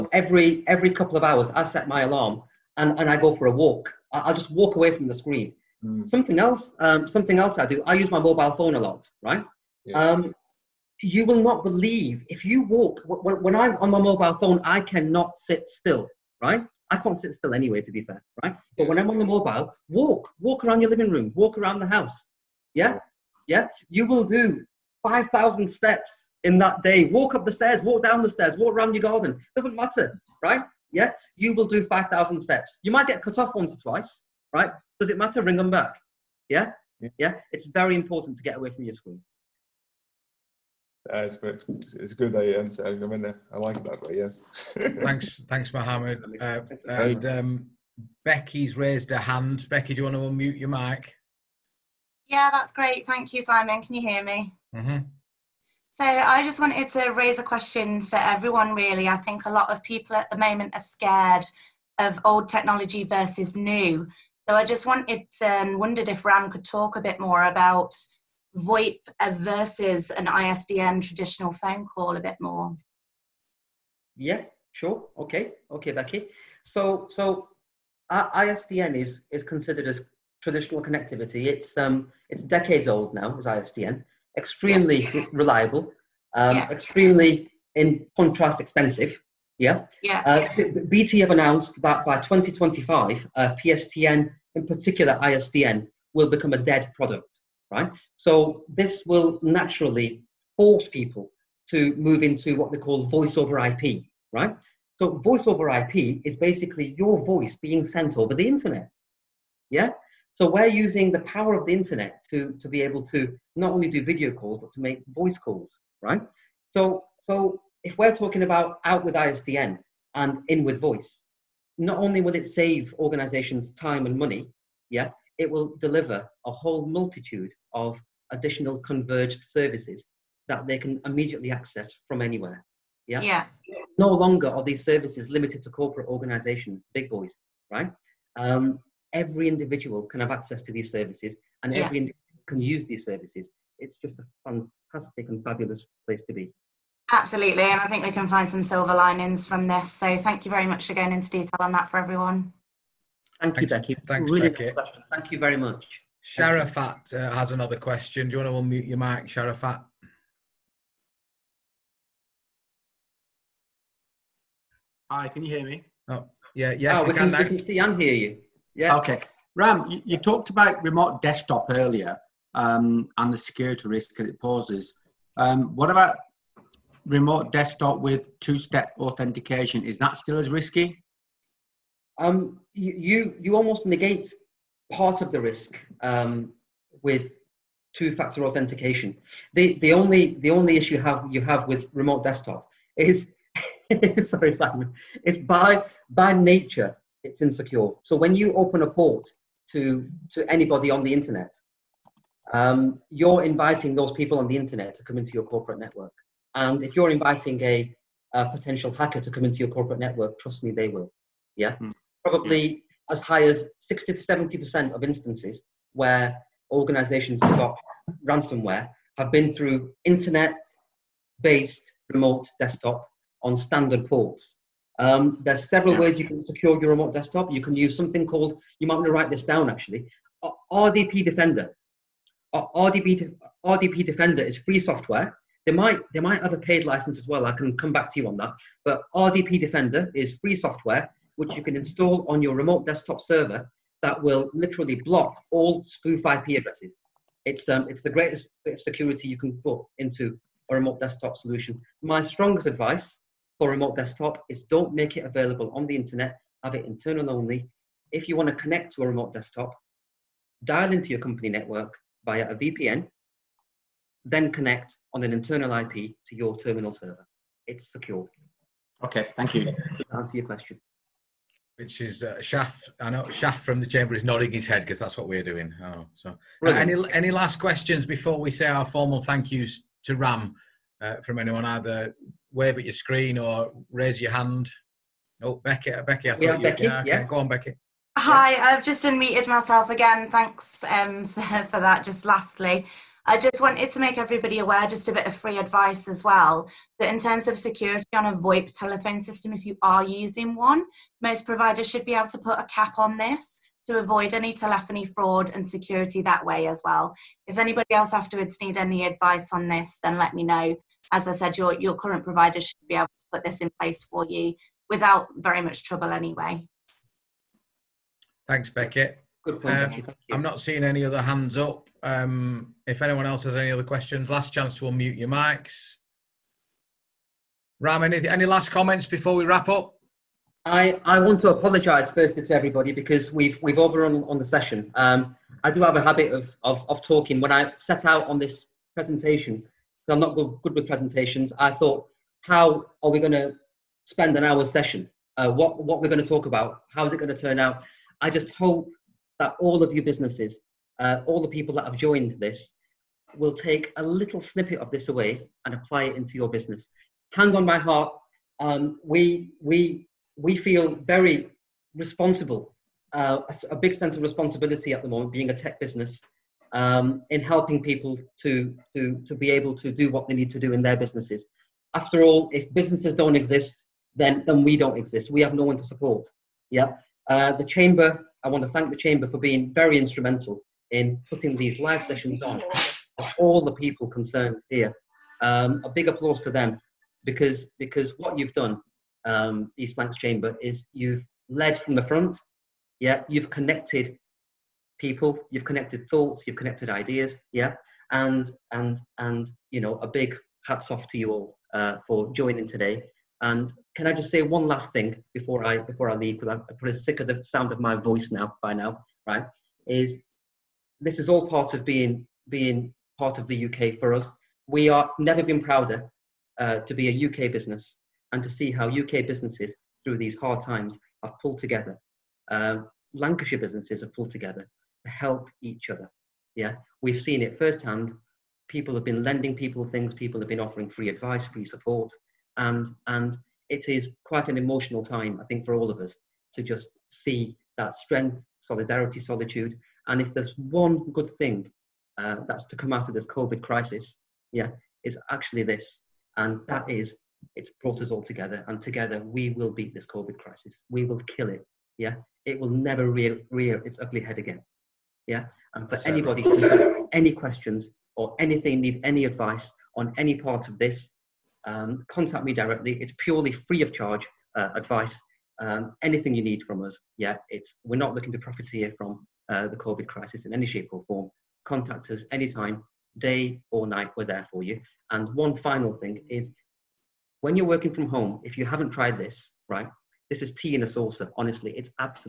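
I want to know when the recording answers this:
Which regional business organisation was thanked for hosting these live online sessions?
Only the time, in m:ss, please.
6:29.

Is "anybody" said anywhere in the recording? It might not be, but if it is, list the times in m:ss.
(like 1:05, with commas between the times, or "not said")
3:20, 5:07, 7:36.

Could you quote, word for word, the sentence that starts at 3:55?
They might, they might have a paid license as well.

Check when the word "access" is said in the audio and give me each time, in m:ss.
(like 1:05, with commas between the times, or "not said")
2:11, 2:20.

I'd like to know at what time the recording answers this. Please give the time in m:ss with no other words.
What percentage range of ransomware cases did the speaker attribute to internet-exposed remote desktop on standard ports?
3:33.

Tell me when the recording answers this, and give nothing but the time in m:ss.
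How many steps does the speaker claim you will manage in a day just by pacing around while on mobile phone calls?
0:25.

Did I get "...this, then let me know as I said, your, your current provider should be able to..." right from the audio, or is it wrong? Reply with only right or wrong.
right.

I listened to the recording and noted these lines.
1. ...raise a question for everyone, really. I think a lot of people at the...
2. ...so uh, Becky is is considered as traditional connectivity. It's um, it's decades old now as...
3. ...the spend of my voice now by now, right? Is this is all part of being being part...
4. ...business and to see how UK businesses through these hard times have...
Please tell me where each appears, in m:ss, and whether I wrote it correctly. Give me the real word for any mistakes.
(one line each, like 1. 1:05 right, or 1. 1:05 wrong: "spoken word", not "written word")
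1. 0:57 right
2. 1:17 wrong: "ISDN", not "Becky"
3. 6:47 wrong: "sound", not "spend"
4. 6:57 right.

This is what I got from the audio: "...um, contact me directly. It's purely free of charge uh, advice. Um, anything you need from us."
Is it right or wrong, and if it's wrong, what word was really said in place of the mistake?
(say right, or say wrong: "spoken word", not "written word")
right.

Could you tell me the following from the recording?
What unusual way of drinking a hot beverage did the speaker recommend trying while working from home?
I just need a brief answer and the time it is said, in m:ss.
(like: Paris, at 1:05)
tea in a saucer, at 8:00.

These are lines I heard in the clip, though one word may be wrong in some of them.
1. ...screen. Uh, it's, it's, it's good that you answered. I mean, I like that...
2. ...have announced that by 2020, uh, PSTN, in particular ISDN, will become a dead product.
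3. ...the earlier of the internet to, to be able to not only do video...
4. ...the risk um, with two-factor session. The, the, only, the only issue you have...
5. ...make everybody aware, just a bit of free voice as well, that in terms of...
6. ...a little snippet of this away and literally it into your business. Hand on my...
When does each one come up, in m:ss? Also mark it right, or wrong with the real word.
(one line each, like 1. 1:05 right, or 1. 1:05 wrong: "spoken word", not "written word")
1. 0:38 right
2. 1:31 wrong: "2025", not "2020"
3. 1:51 wrong: "power", not "earlier"
4. 3:05 wrong: "authentication", not "session"
5. 4:53 wrong: "advice", not "voice"
6. 5:53 wrong: "apply", not "literally".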